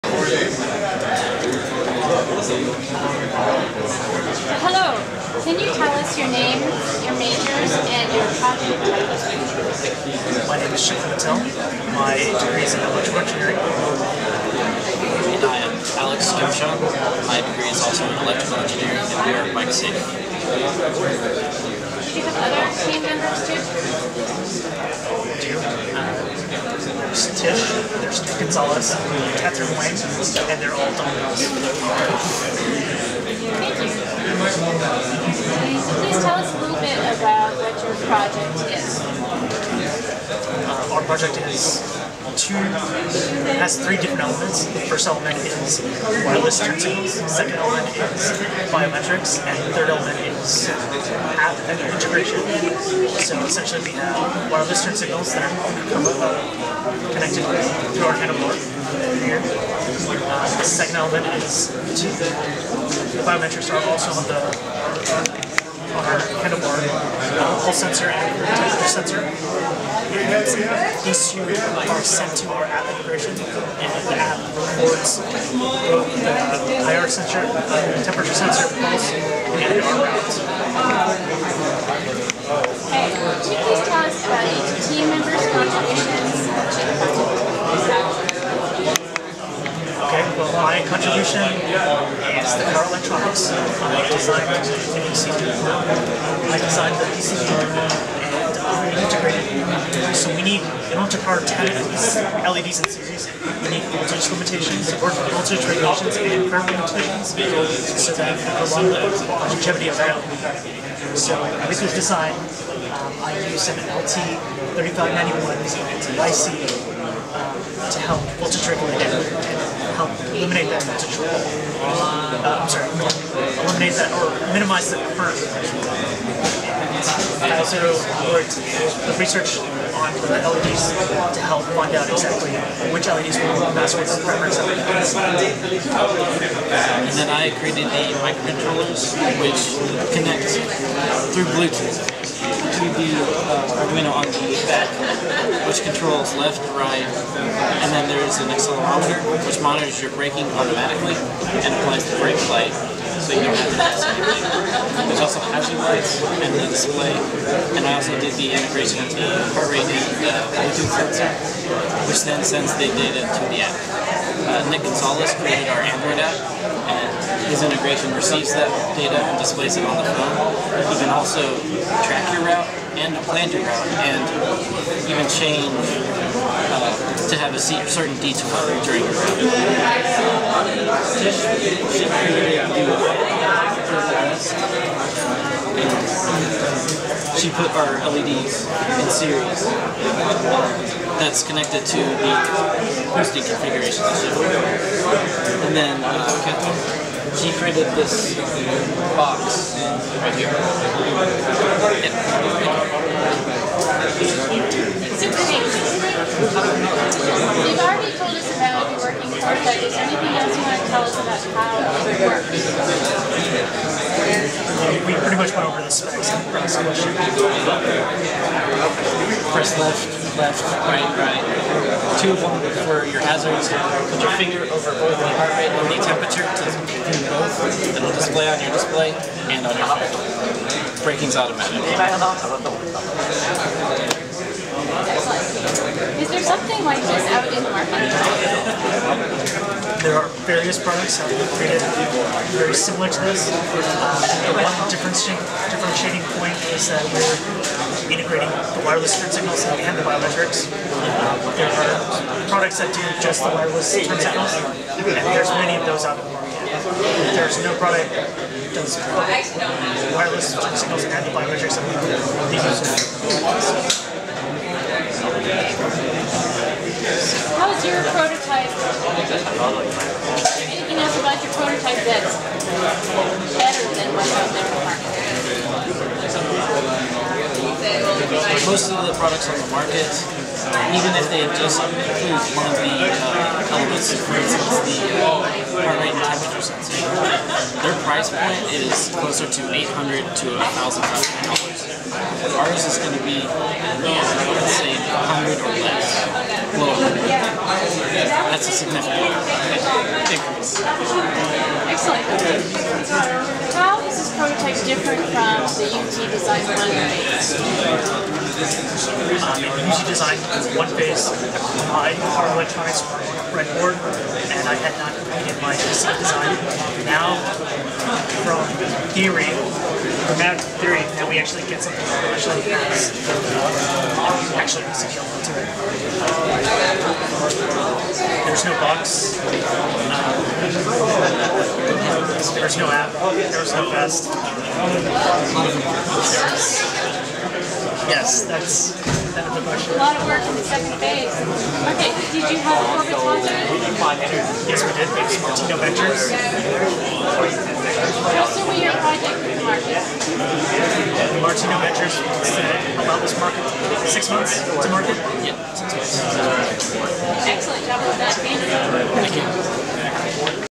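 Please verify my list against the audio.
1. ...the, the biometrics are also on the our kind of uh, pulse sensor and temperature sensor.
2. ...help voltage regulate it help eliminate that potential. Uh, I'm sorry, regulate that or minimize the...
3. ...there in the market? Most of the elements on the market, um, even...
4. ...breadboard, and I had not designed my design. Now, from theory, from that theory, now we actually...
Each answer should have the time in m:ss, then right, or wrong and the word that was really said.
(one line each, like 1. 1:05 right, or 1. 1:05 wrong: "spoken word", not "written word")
1. 1:02 right
2. 1:57 wrong: "eliminate", not "regulate"
3. 4:34 wrong: "products", not "elements"
4. 5:13 wrong: "completed", not "designed".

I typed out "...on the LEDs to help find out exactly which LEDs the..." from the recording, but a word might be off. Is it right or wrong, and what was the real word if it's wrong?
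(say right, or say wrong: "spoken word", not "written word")
right.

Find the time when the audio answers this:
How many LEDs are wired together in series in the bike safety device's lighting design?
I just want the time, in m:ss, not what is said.
1:41.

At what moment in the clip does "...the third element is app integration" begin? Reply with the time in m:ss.
0:49.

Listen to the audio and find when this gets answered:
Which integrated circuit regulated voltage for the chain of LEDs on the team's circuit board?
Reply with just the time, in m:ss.
1:53.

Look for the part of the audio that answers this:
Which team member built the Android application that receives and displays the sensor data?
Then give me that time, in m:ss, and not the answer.
2:44.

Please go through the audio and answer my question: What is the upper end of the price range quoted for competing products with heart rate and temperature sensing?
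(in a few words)
$1,000.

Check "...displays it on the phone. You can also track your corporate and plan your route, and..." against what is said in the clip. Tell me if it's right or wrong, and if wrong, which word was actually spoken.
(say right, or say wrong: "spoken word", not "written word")
wrong: "route", not "corporate".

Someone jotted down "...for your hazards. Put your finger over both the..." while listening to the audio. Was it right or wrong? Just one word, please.
right.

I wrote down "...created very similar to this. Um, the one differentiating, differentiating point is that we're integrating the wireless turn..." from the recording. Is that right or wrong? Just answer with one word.
right.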